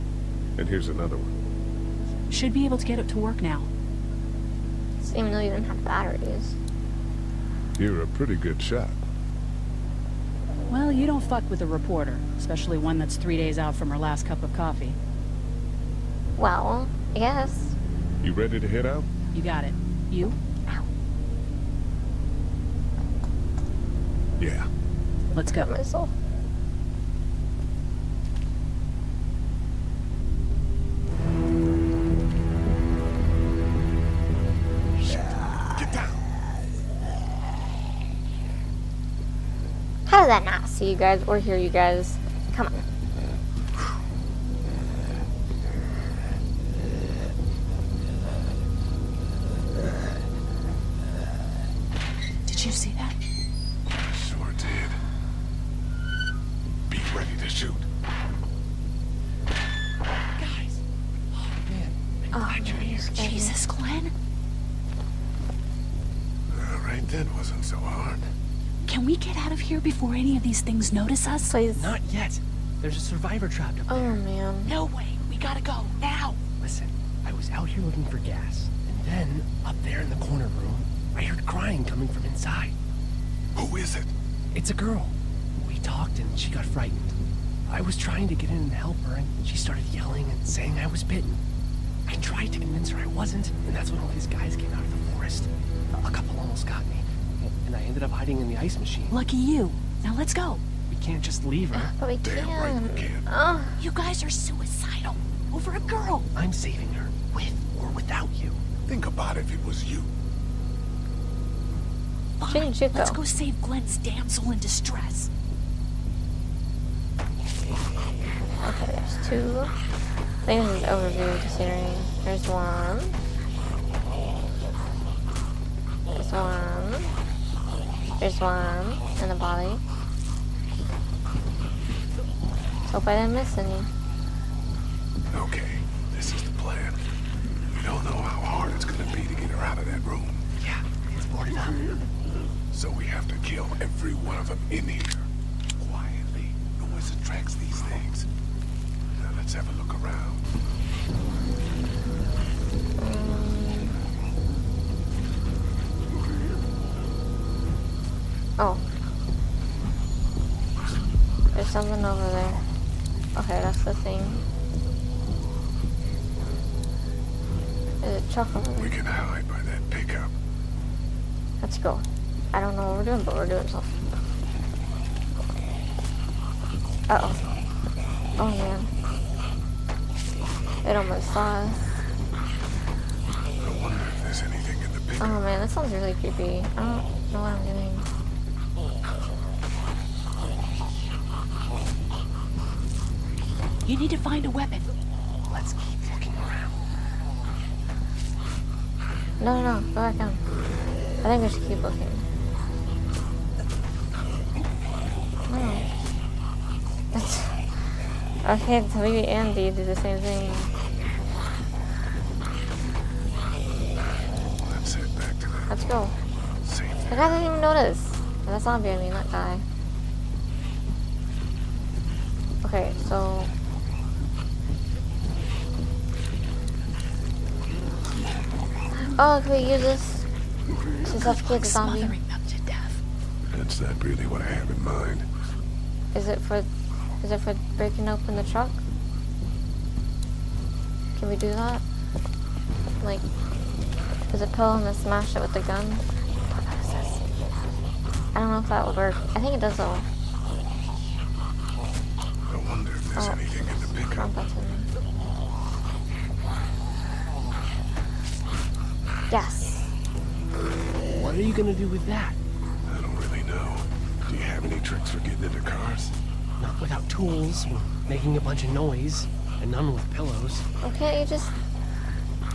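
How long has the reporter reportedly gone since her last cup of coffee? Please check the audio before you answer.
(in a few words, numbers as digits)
3 days.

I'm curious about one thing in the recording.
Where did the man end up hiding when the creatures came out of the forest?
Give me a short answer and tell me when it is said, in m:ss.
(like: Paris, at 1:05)
The ice machine, at 1:38.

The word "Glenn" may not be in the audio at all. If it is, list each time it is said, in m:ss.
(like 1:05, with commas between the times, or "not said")
1:03, 1:53.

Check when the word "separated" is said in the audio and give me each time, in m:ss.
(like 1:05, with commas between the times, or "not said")
not said.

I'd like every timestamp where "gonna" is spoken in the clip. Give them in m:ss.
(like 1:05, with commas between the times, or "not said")
2:18, 4:21.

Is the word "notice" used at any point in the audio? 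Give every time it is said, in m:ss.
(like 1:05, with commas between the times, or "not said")
1:10, 3:37.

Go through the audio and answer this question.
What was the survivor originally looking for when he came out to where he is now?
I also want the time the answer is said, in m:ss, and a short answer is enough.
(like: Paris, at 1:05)
Gas, at 1:18.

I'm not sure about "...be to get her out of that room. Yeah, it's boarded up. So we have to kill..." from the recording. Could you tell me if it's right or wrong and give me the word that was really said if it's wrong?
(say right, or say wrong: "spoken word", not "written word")
right.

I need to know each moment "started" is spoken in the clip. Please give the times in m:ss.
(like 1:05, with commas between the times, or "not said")
1:29.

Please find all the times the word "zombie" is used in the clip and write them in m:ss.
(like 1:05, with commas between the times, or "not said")
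3:38, 3:51.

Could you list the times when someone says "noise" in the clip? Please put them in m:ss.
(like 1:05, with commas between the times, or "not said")
2:26, 4:28.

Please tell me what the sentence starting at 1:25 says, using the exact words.
We talked and she got frightened.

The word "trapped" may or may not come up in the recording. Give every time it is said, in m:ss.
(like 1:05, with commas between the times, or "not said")
1:13.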